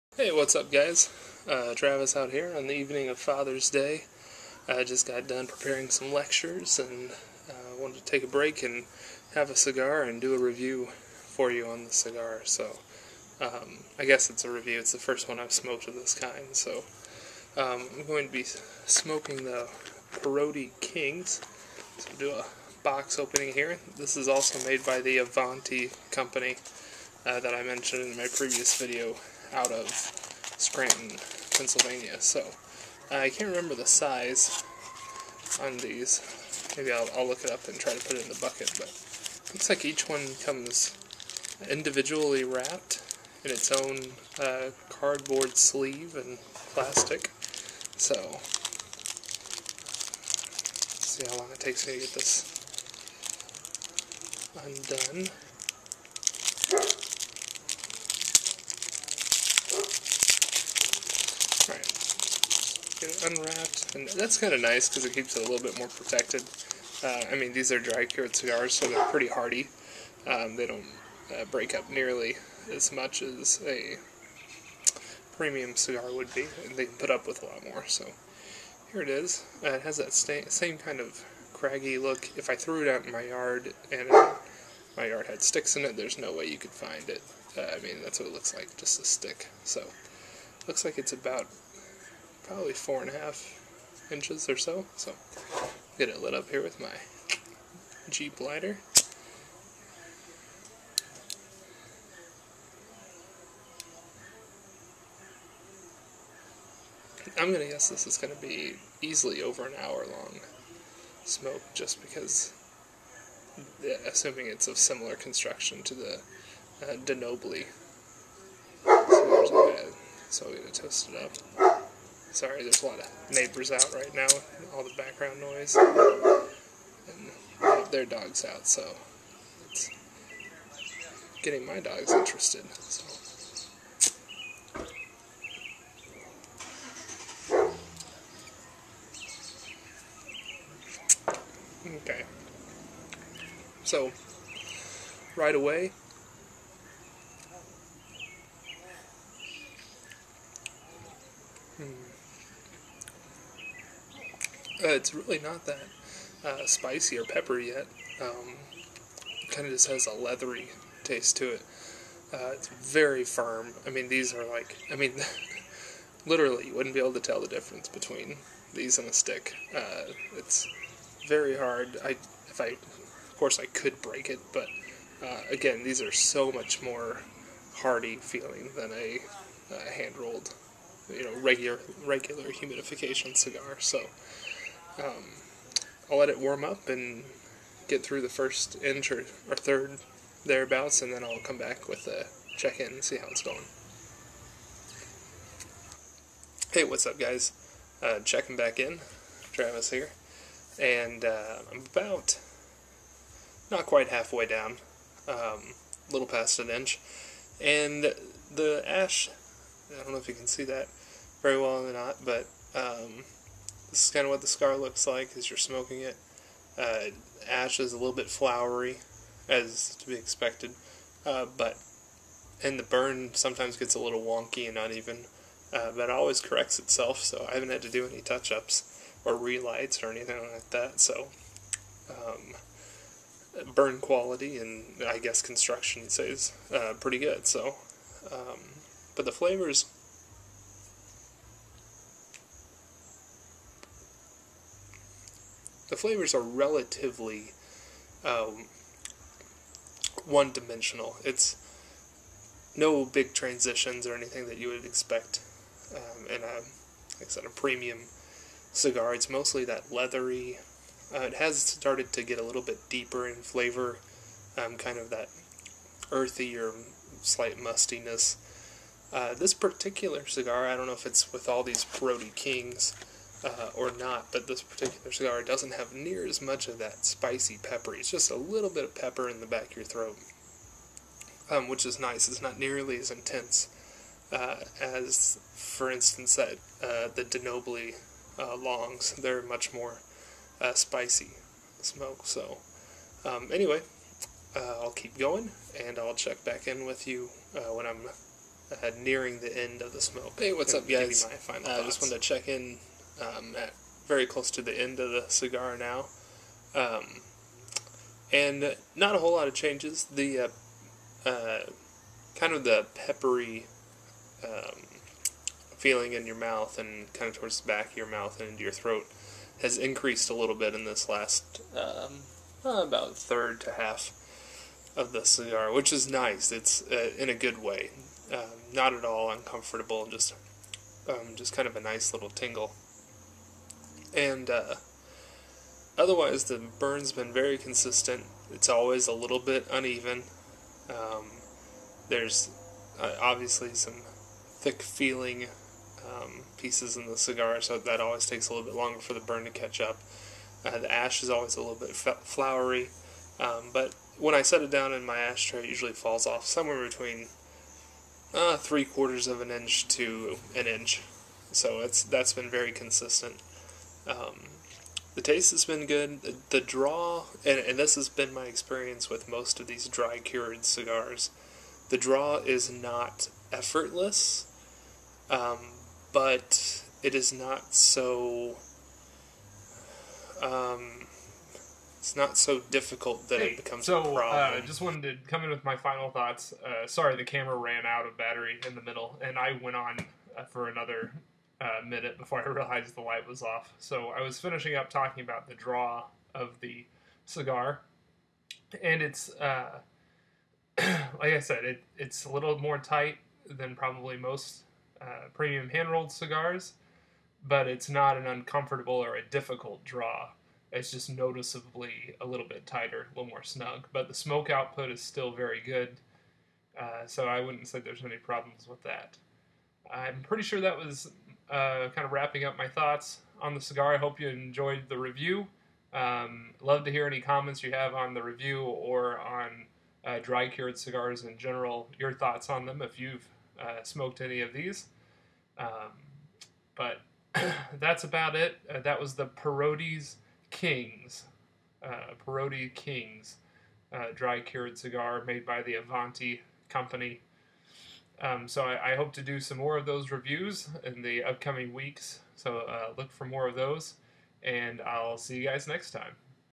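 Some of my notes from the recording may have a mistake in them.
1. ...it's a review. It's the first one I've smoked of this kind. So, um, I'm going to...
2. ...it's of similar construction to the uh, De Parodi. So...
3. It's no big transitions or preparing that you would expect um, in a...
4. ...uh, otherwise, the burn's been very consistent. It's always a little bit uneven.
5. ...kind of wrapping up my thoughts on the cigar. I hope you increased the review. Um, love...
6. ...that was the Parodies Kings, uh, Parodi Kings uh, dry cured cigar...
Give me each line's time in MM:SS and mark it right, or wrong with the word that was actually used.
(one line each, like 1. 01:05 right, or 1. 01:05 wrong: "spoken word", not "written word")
1. 00:14 right
2. 01:54 wrong: "Nobili", not "Parodi"
3. 04:11 wrong: "anything", not "preparing"
4. 05:34 right
5. 07:01 wrong: "enjoyed", not "increased"
6. 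07:18 wrong: "Perotti", not "Parodi".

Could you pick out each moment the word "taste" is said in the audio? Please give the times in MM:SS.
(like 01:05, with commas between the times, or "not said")
02:41, 06:05.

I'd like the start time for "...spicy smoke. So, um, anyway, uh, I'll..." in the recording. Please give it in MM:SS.
04:50.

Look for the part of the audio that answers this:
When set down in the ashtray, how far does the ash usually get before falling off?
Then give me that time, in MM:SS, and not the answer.
05:58.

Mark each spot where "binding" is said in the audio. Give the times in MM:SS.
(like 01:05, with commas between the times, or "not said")
not said.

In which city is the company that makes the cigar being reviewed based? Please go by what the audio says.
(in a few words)
Scranton, Pennsylvania.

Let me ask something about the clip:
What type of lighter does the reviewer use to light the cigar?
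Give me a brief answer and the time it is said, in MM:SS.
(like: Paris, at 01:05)
Jeep lighter, at 01:38.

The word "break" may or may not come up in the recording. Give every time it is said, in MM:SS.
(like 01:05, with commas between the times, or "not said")
00:08, 01:11, 02:54.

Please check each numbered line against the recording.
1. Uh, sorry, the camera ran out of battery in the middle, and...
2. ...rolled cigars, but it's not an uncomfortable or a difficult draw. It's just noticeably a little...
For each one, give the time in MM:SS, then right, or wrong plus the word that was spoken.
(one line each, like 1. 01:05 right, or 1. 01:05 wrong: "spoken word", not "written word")
1. 06:26 right
2. 06:45 right.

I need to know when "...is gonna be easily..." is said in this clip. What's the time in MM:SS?
01:48.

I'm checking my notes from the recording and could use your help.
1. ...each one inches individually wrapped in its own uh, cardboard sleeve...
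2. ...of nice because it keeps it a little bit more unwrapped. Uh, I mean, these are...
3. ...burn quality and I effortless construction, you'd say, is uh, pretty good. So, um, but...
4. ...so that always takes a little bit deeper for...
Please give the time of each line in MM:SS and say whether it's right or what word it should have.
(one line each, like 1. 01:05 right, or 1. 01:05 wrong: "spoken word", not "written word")
1. 00:39 wrong: "comes", not "inches"
2. 01:04 wrong: "protected", not "unwrapped"
3. 03:53 wrong: "guess", not "effortless"
4. 05:47 wrong: "longer", not "deeper".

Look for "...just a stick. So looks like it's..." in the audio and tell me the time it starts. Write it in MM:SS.
01:28.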